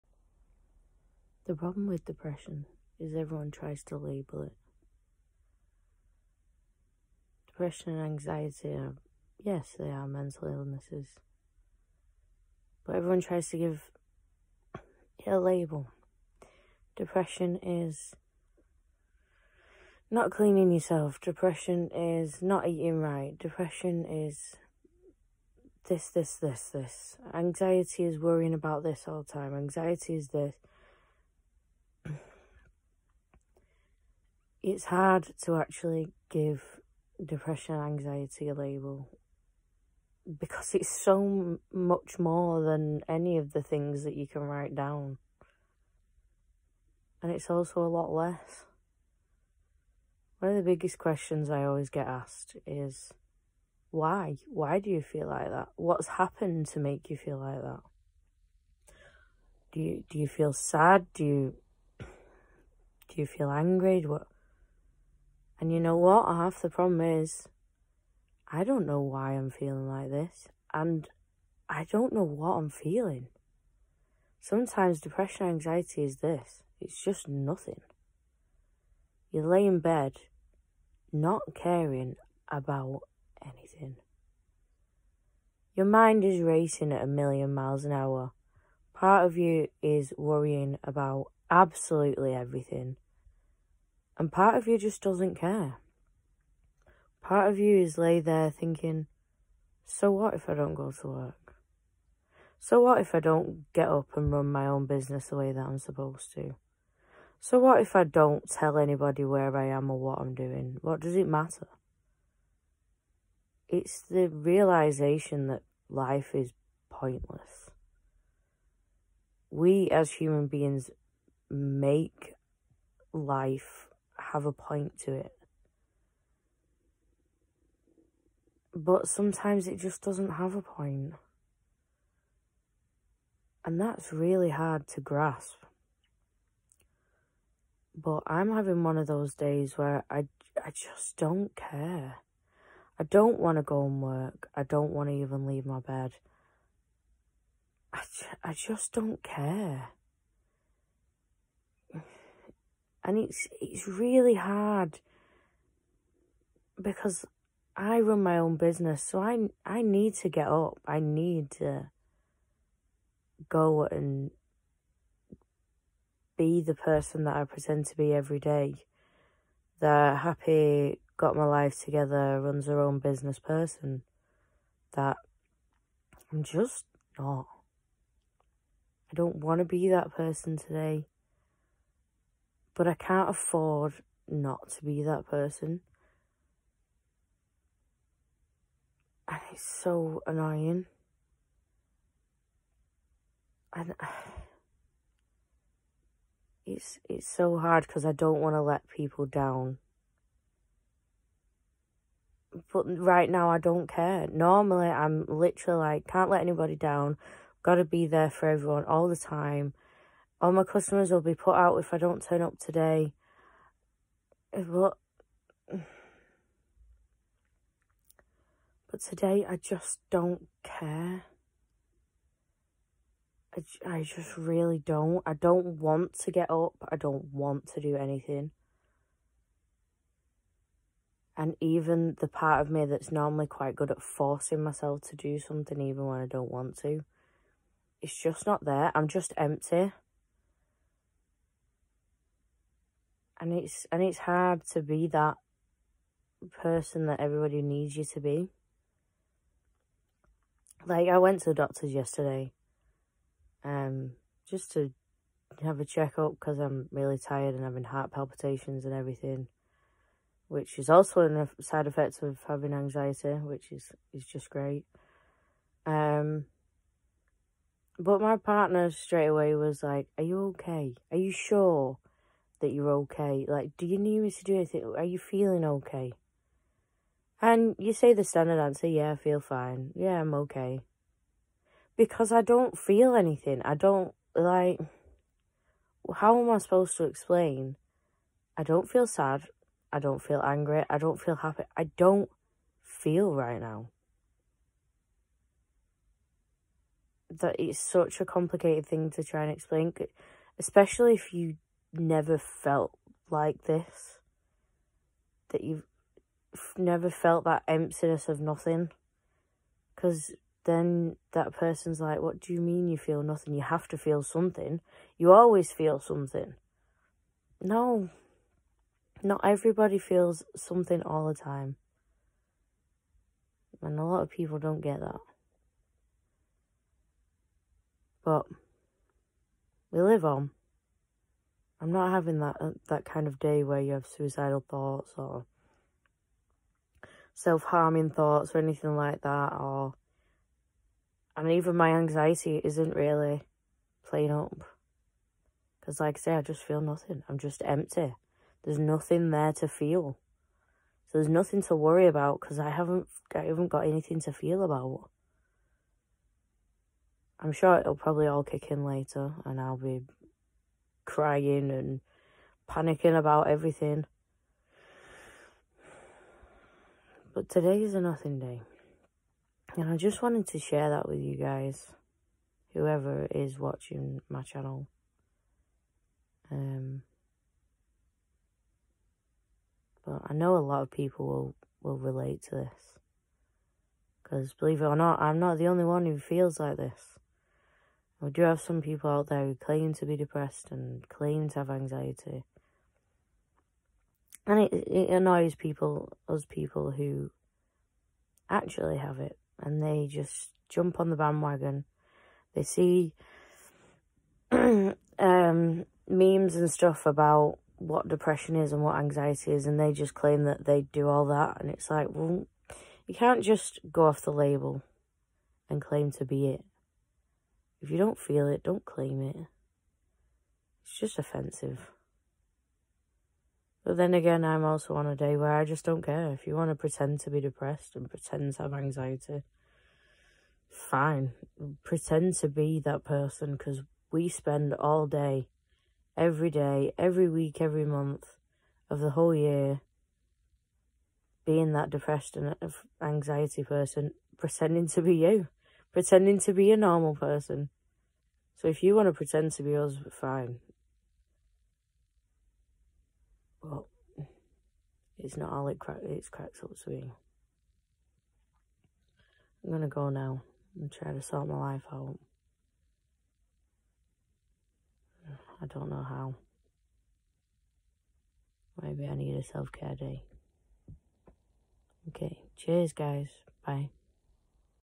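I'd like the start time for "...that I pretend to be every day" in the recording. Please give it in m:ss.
2:47.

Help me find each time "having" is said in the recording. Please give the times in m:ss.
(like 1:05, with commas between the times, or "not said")
2:18, 4:17, 4:22, 5:32.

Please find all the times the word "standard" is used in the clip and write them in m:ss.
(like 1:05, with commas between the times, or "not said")
4:38.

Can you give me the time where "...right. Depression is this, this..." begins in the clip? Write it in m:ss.
0:23.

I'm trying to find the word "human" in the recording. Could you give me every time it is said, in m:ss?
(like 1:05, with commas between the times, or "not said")
2:00.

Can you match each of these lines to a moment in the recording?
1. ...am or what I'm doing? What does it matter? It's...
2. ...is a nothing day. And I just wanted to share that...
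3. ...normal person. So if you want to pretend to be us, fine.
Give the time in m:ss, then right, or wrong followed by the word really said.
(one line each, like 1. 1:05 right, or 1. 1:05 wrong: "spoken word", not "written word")
1. 1:49 right
2. 6:07 right
3. 7:26 right.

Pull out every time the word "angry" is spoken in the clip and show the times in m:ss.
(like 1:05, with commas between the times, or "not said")
1:03, 4:50.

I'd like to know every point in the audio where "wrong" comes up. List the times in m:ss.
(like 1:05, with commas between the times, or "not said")
not said.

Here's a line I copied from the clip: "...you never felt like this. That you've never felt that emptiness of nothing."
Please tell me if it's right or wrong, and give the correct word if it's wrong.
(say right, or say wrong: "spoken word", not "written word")
right.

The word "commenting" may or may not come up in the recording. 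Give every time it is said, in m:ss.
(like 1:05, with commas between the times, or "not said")
not said.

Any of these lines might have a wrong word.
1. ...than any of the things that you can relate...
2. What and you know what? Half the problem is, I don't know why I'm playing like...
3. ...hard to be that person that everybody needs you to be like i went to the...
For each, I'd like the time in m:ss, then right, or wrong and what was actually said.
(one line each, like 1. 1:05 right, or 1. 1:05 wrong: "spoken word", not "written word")
1. 0:42 wrong: "write", not "relate"
2. 1:04 wrong: "feeling", not "playing"
3. 4:04 right.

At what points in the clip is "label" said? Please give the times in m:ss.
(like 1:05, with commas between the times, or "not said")
0:03, 0:15, 0:38, 6:54.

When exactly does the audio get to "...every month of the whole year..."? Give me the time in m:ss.
7:17.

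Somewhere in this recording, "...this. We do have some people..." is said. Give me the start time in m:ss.
6:26.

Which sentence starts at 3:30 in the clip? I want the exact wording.
All my customers will be put out if I don't turn up today.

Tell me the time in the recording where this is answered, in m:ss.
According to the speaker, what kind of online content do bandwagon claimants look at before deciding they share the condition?
6:46.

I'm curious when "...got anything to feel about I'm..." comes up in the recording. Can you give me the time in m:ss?
5:53.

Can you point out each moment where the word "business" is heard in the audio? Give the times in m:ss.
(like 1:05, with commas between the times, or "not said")
1:44, 2:38, 2:52.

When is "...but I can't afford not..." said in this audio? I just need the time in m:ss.
3:02.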